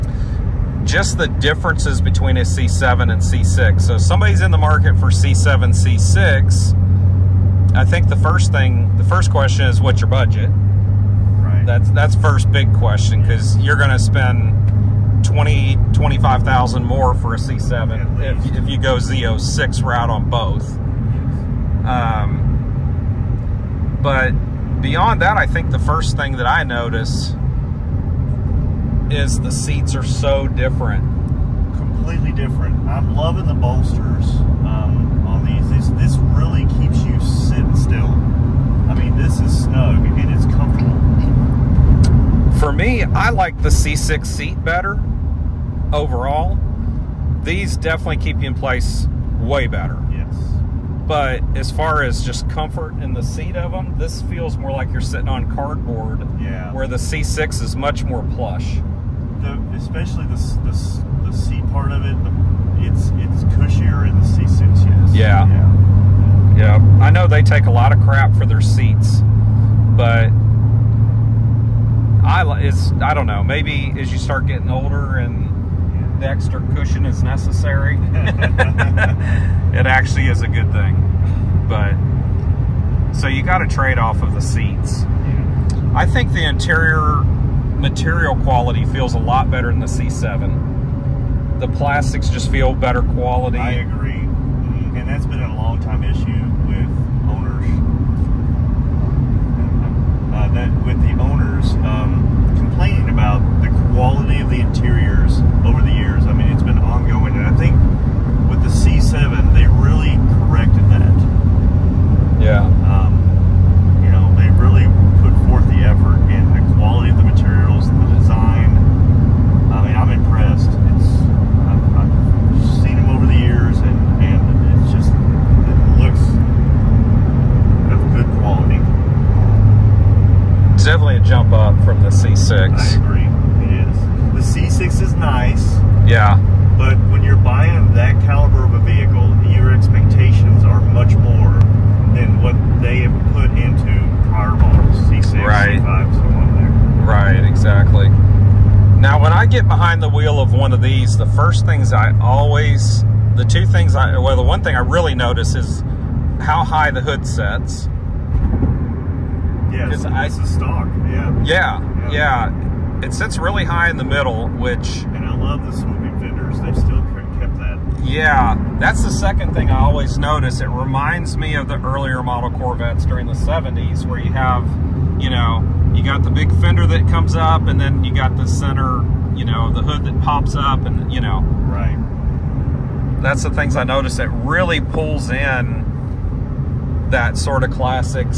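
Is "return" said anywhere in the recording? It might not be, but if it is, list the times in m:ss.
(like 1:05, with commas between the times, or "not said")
not said.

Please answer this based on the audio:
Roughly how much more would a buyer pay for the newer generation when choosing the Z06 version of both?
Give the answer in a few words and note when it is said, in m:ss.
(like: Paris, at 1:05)
20,000 to 25,000, at 0:15.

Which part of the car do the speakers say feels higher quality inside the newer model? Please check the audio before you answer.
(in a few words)
The plastics.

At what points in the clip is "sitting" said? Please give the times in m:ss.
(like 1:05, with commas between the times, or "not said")
0:37, 0:54.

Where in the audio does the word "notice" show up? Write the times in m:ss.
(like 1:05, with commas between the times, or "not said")
0:26, 2:35, 2:50, 3:03.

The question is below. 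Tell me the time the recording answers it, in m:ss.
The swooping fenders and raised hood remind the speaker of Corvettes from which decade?
2:53.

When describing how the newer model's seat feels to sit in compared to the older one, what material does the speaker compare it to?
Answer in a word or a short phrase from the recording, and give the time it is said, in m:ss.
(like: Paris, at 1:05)
Cardboard, at 0:55.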